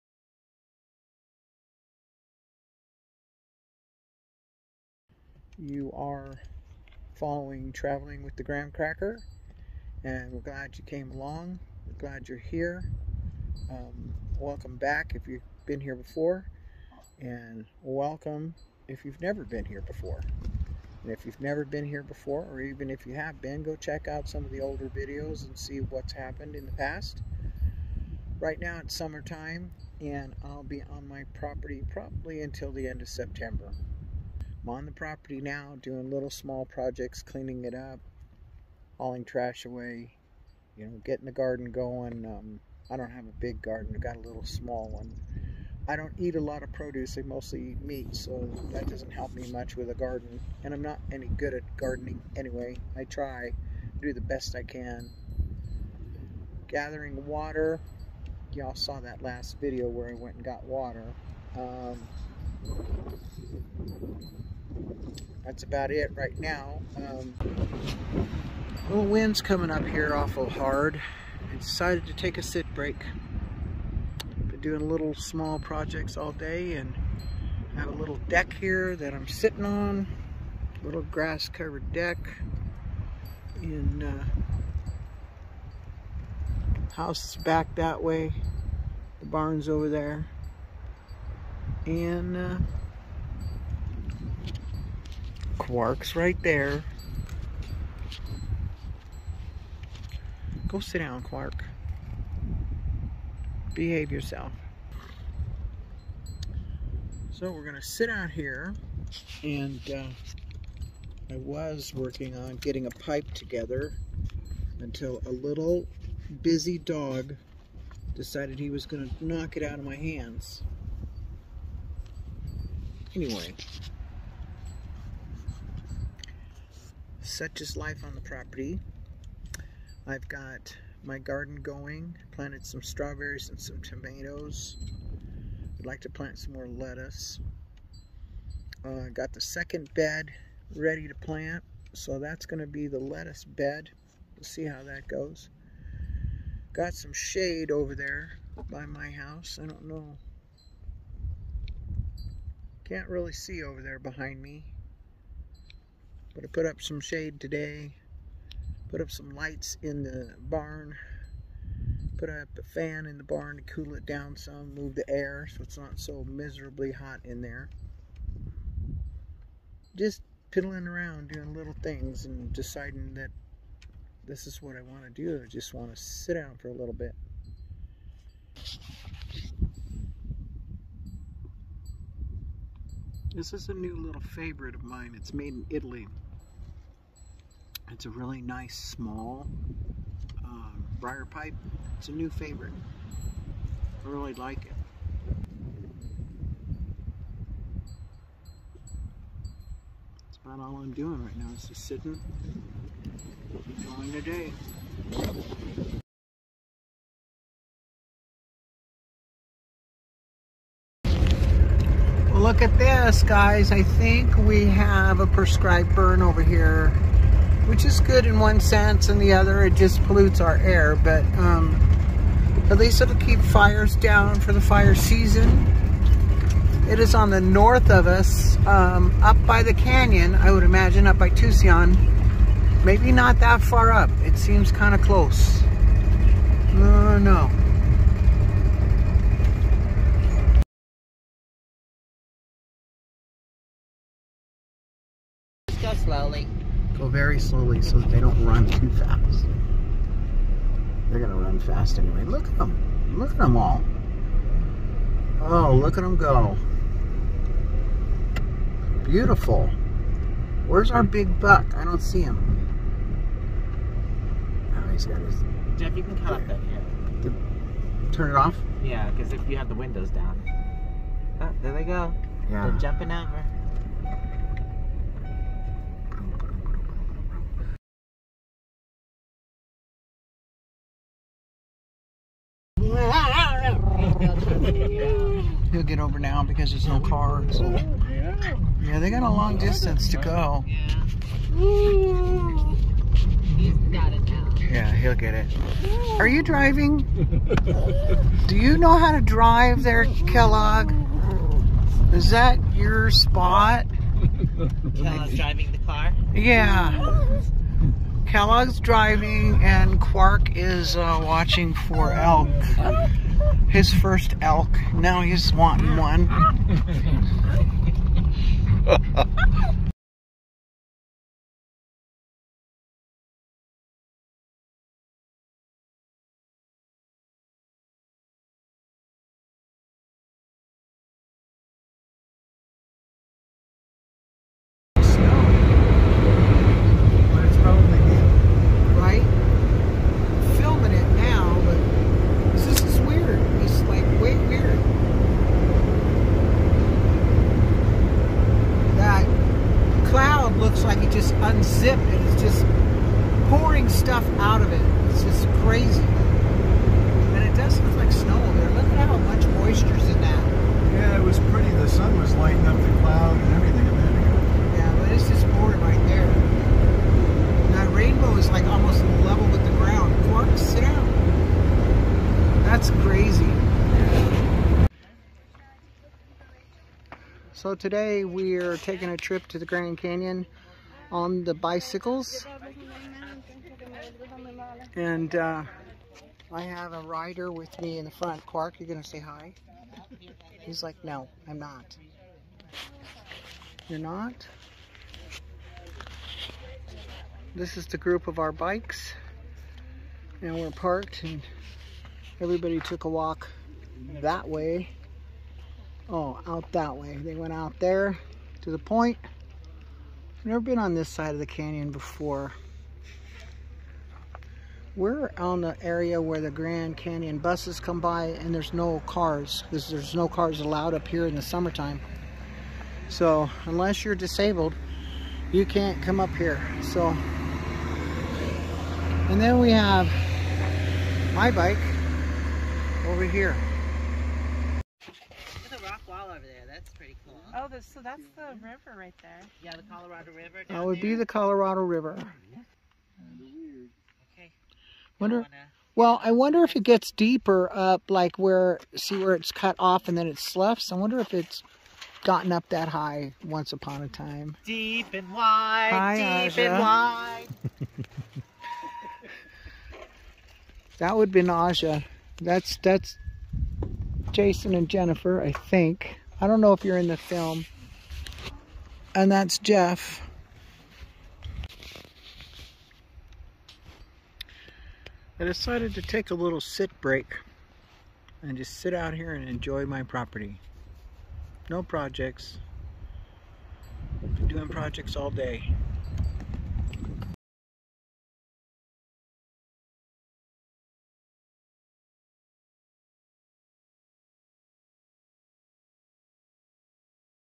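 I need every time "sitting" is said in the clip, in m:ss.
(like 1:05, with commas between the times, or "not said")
1:19, 3:21.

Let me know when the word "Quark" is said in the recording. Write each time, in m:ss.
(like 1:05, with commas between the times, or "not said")
1:35, 1:41, 5:09, 6:28.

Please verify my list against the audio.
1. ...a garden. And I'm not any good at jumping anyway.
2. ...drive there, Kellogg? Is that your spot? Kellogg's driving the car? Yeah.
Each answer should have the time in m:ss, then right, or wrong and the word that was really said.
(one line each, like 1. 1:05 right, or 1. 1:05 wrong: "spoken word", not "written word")
1. 0:49 wrong: "gardening", not "jumping"
2. 4:59 right.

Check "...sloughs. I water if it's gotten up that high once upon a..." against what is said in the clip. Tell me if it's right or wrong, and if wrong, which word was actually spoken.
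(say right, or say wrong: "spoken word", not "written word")
wrong: "wonder", not "water".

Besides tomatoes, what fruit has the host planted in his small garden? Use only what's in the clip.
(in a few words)
Strawberries.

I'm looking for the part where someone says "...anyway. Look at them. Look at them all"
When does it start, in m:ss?
4:11.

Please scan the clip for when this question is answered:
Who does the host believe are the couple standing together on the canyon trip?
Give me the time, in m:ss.
7:44.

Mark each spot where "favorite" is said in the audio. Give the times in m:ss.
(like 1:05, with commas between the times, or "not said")
3:04, 3:12.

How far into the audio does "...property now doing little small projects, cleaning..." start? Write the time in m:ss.
0:34.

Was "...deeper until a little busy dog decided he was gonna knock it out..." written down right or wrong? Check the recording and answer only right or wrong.
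wrong.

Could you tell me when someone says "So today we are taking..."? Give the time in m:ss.
6:17.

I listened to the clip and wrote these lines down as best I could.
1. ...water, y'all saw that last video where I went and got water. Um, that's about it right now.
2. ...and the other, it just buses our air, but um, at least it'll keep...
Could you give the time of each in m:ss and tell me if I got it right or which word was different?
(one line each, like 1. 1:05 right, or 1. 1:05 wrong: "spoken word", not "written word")
1. 0:57 right
2. 3:39 wrong: "pollutes", not "buses".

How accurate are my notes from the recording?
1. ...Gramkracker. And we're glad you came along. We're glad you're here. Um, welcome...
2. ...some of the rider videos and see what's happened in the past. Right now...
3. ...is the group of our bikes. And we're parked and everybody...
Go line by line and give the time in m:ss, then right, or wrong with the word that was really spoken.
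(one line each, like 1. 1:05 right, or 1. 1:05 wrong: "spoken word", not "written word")
1. 0:08 right
2. 0:24 wrong: "older", not "rider"
3. 6:37 right.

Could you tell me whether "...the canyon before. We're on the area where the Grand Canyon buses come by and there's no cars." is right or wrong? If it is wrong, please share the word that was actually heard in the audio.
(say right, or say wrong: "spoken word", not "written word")
right.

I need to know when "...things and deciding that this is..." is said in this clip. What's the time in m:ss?
2:51.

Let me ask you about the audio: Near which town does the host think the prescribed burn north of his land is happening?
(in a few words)
Tusayan.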